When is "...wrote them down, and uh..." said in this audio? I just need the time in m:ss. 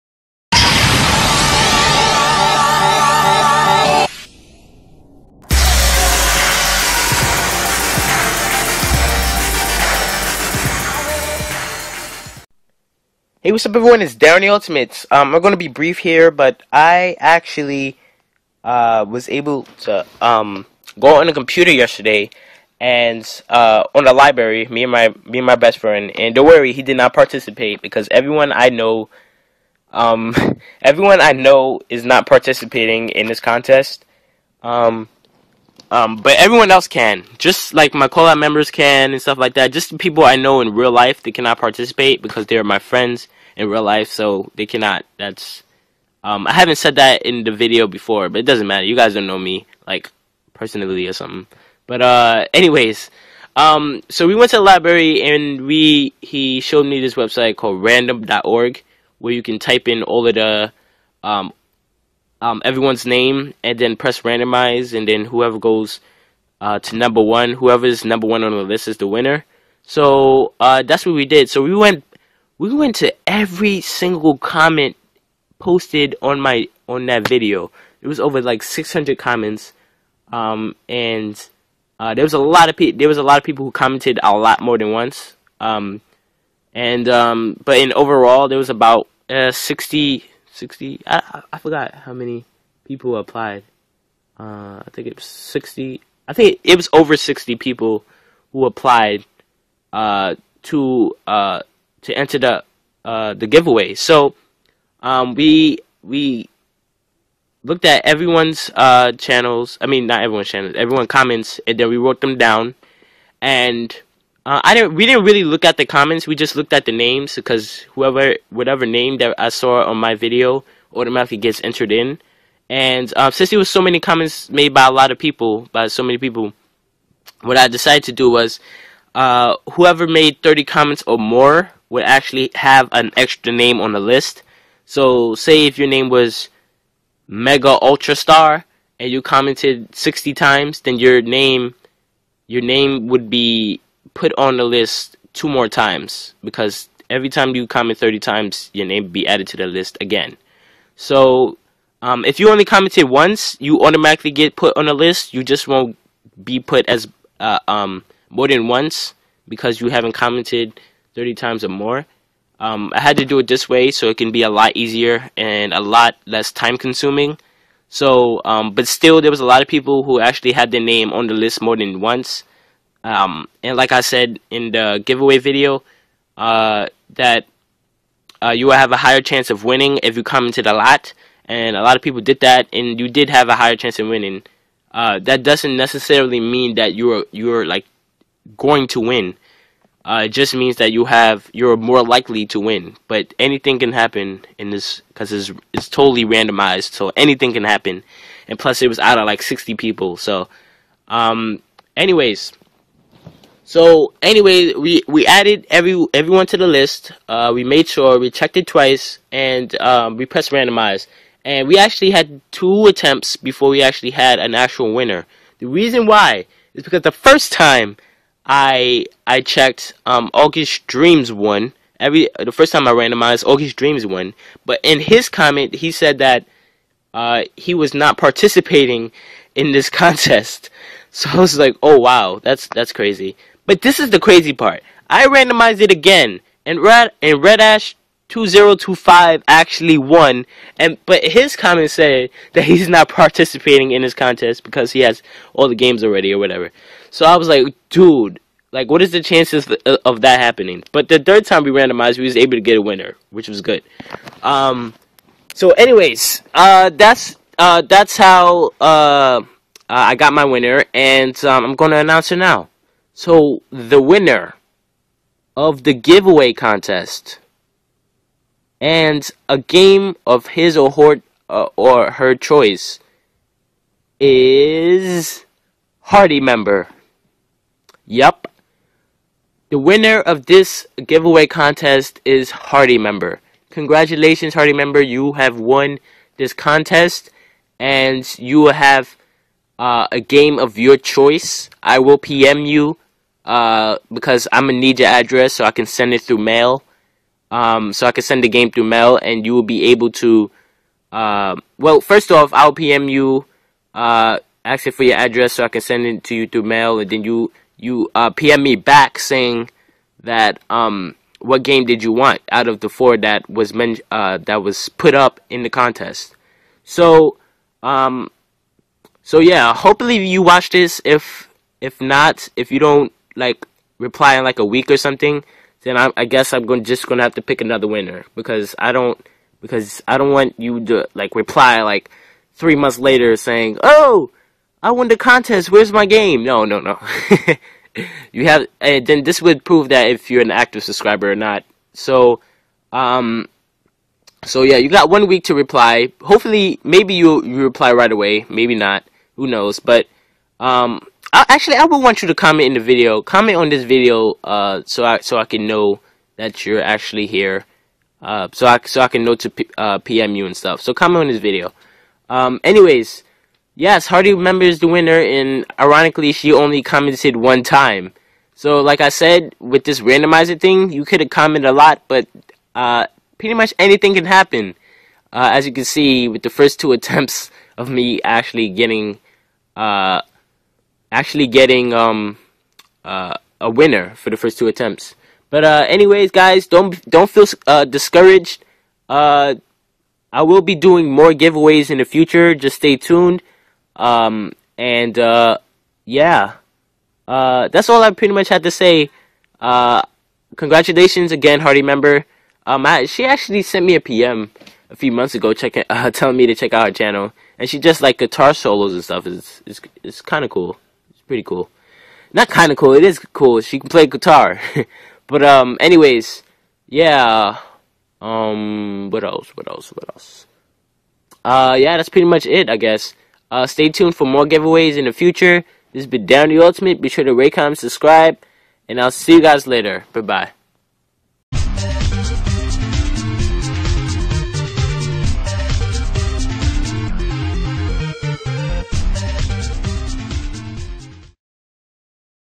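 1:51.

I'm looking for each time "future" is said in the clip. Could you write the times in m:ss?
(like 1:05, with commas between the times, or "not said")
6:32, 7:05.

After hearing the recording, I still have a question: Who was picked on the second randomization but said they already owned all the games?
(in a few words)
Red Ash 2025.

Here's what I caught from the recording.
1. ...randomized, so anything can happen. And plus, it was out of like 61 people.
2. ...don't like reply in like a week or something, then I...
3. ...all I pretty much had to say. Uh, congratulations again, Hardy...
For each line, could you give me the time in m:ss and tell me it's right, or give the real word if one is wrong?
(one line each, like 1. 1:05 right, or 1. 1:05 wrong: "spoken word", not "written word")
1. 3:16 wrong: "60", not "61"
2. 5:22 right
3. 6:37 right.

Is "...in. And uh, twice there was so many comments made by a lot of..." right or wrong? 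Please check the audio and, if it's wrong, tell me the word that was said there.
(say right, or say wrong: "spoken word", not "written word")
wrong: "since", not "twice".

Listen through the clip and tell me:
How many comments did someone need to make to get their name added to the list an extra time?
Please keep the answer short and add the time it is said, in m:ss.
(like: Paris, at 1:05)
30, at 2:10.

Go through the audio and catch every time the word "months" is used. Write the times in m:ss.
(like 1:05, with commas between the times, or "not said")
5:32, 6:45.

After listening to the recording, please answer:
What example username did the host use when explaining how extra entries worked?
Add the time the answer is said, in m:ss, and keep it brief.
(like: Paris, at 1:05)
Mega Ultra Star, at 2:17.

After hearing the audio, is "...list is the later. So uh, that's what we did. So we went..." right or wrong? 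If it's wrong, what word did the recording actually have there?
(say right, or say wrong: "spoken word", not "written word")
wrong: "winner", not "later".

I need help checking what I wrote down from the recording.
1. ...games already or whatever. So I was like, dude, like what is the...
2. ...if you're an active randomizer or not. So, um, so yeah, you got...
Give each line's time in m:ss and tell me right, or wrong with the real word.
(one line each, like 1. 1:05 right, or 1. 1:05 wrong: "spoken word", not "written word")
1. 4:05 right
2. 5:40 wrong: "subscriber", not "randomizer".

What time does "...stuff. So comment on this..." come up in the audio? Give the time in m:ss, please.
6:00.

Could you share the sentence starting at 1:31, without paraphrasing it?
I, I forgot how many people applied.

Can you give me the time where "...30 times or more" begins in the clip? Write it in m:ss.
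2:41.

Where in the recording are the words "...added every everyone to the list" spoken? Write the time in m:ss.
3:25.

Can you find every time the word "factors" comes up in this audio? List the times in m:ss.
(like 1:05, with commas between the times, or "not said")
not said.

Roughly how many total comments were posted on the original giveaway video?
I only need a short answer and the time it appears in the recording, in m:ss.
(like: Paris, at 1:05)
over 600, at 1:18.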